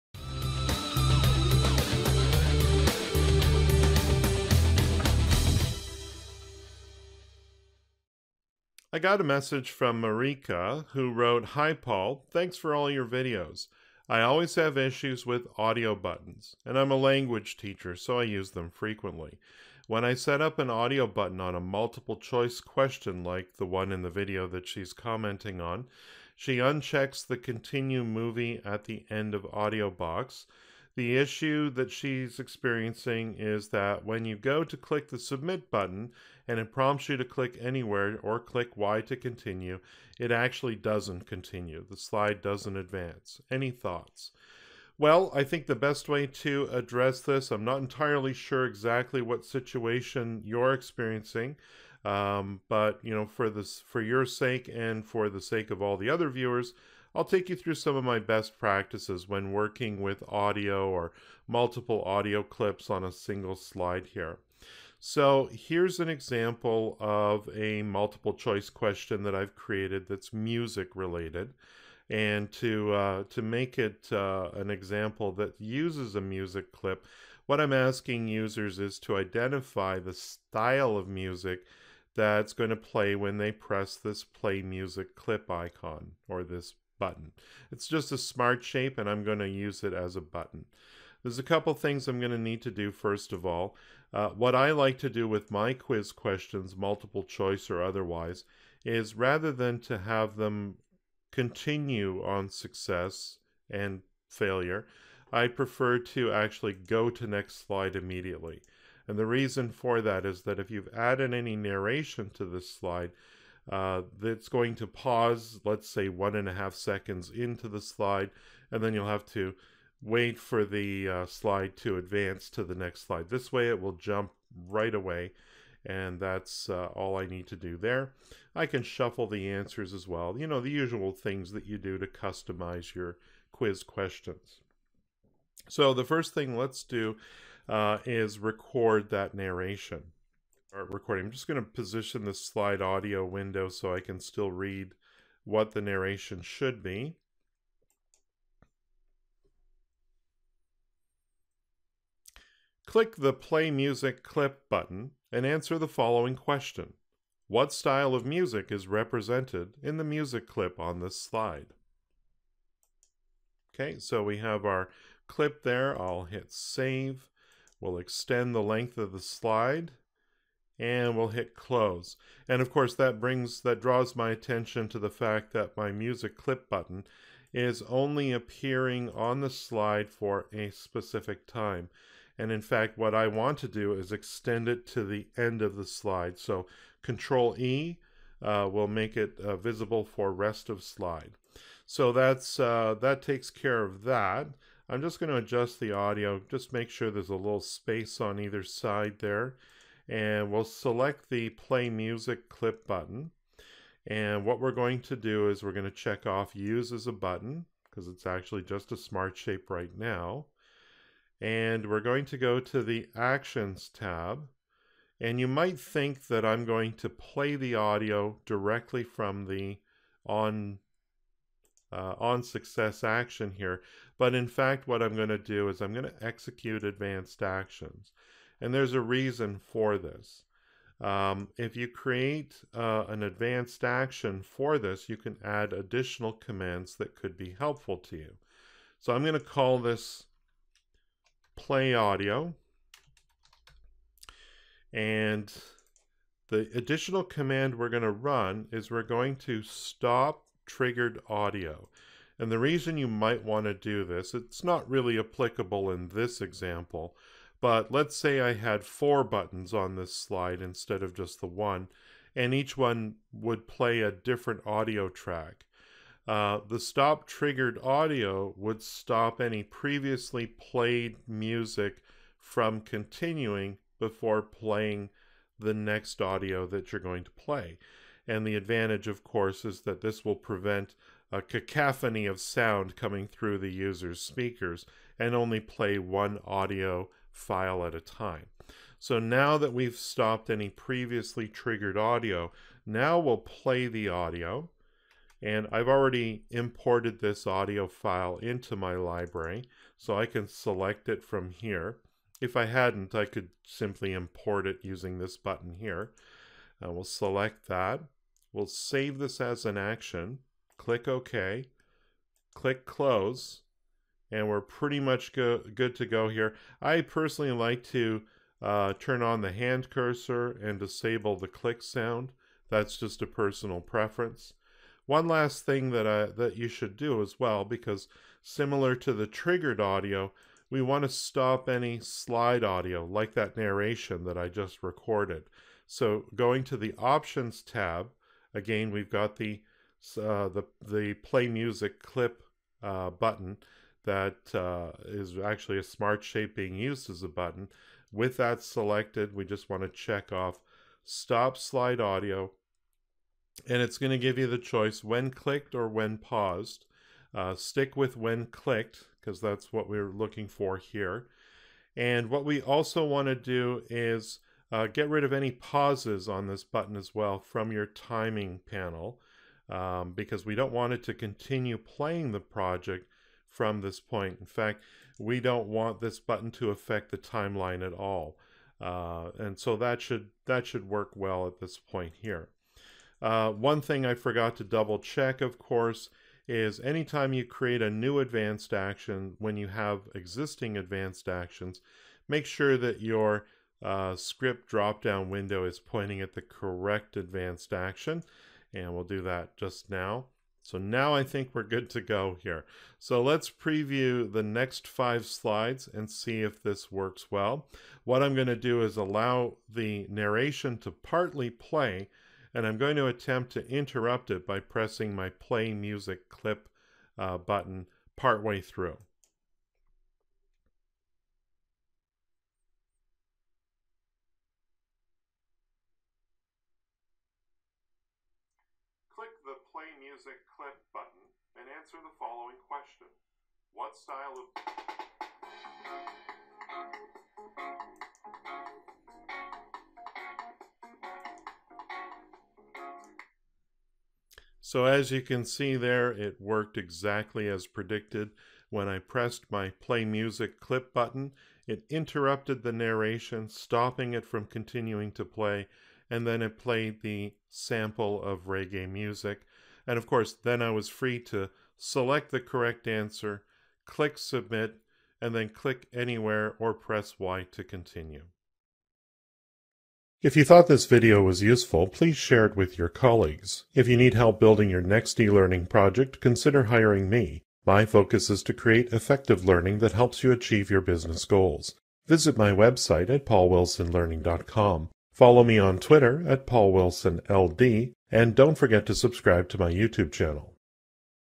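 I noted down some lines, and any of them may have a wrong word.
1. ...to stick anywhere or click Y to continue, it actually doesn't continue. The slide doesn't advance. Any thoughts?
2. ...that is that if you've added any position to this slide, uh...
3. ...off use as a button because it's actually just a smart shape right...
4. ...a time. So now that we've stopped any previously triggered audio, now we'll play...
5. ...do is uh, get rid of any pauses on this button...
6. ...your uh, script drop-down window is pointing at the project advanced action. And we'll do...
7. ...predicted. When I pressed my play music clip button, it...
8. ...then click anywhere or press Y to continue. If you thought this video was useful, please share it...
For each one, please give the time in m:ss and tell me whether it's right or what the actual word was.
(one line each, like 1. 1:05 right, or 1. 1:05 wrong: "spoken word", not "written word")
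1. 0:37 wrong: "click", not "stick"
2. 1:50 wrong: "narration", not "position"
3. 3:26 right
4. 4:47 right
5. 6:03 right
6. 6:33 wrong: "correct", not "project"
7. 7:27 right
8. 7:45 right.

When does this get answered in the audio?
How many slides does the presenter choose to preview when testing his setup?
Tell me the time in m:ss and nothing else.
6:44.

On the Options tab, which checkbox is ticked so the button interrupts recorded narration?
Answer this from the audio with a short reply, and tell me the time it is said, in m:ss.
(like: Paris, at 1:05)
stop slide audio, at 5:51.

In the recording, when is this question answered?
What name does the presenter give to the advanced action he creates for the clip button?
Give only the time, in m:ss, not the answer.
4:01.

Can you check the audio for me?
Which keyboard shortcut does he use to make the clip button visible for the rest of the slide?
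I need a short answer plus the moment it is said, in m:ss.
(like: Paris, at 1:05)
Control E, at 3:07.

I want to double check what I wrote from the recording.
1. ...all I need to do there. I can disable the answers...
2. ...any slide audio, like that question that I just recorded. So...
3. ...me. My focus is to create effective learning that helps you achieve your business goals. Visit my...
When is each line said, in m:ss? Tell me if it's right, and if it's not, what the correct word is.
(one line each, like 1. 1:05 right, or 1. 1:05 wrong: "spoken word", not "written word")
1. 2:06 wrong: "shuffle", not "disable"
2. 5:31 wrong: "narration", not "question"
3. 7:57 right.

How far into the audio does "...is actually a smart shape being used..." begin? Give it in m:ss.
5:45.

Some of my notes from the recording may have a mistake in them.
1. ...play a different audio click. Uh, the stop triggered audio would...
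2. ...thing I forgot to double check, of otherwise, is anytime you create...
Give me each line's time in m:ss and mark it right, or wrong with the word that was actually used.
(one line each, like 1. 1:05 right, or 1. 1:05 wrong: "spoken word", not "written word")
1. 4:23 wrong: "track", not "click"
2. 6:23 wrong: "course", not "otherwise".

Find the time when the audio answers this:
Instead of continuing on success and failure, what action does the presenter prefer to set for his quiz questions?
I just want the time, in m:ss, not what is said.
1:46.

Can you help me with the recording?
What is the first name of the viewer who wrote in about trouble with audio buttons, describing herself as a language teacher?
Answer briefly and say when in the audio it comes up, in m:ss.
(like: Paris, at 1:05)
Marika, at 0:10.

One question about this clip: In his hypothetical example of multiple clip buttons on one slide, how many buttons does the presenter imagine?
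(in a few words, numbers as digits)
4.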